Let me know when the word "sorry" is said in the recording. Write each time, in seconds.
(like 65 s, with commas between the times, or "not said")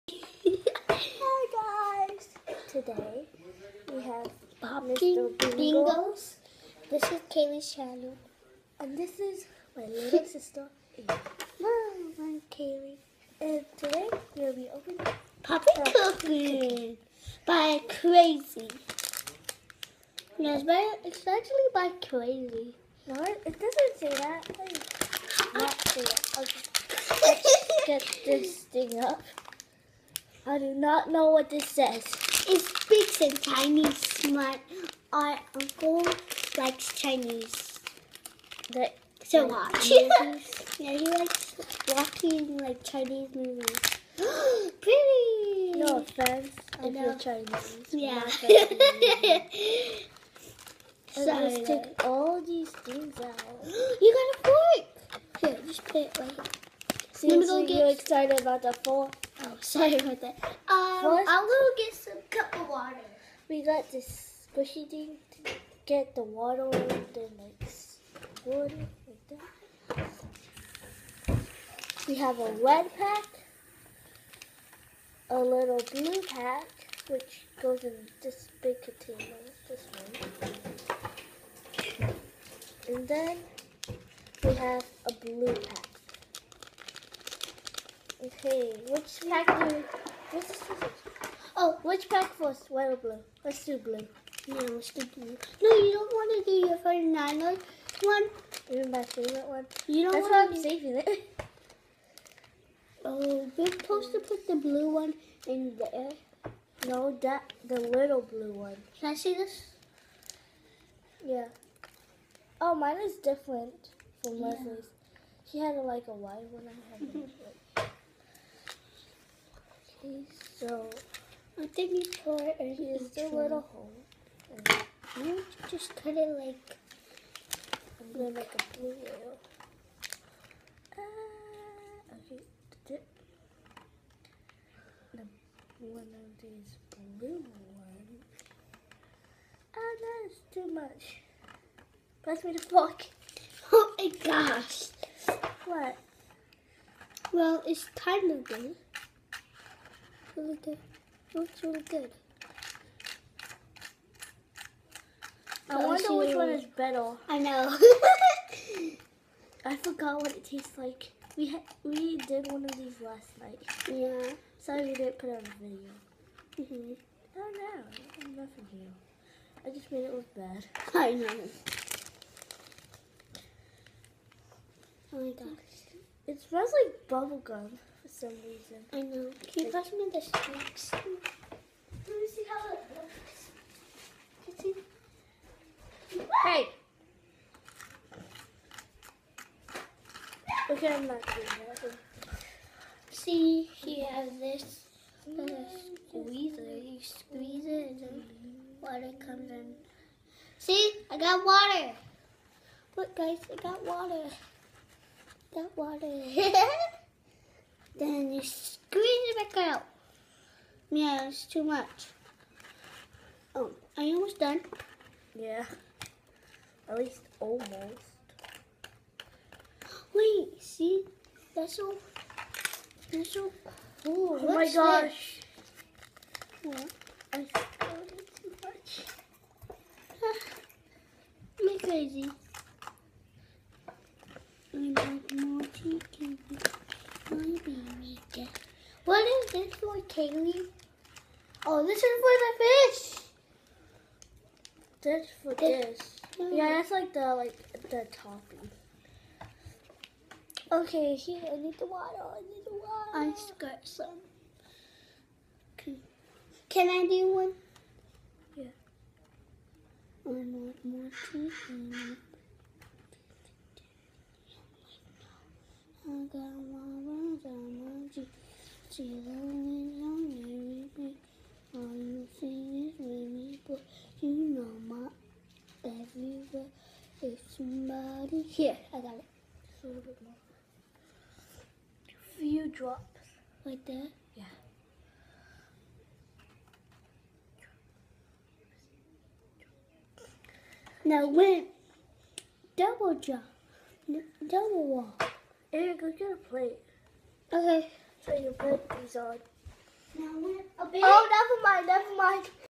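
59 s, 164 s.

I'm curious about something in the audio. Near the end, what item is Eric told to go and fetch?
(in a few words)
a plate.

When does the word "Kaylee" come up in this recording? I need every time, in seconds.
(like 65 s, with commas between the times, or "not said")
7 s, 12 s, 240 s.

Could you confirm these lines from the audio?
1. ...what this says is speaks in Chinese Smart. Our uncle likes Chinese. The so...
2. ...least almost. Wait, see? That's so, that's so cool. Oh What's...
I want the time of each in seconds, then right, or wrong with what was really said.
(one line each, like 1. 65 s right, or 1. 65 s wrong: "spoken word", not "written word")
1. 31 s right
2. 216 s right.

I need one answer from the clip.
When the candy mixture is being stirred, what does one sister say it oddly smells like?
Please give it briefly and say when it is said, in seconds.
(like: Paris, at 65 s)
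bubble gum, at 177 s.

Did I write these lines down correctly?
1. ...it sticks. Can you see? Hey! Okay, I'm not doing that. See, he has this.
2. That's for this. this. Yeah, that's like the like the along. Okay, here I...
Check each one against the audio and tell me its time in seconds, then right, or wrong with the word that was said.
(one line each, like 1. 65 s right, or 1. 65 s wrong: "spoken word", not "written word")
1. 182 s wrong: "looks", not "sticks"
2. 245 s wrong: "topping", not "along".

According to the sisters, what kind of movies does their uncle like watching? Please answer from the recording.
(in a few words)
Chinese movies.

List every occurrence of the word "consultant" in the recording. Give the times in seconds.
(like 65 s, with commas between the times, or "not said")
not said.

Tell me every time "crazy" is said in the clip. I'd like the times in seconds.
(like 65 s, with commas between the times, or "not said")
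17 s, 22 s, 231 s.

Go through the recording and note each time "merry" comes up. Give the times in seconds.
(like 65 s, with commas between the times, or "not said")
270 s.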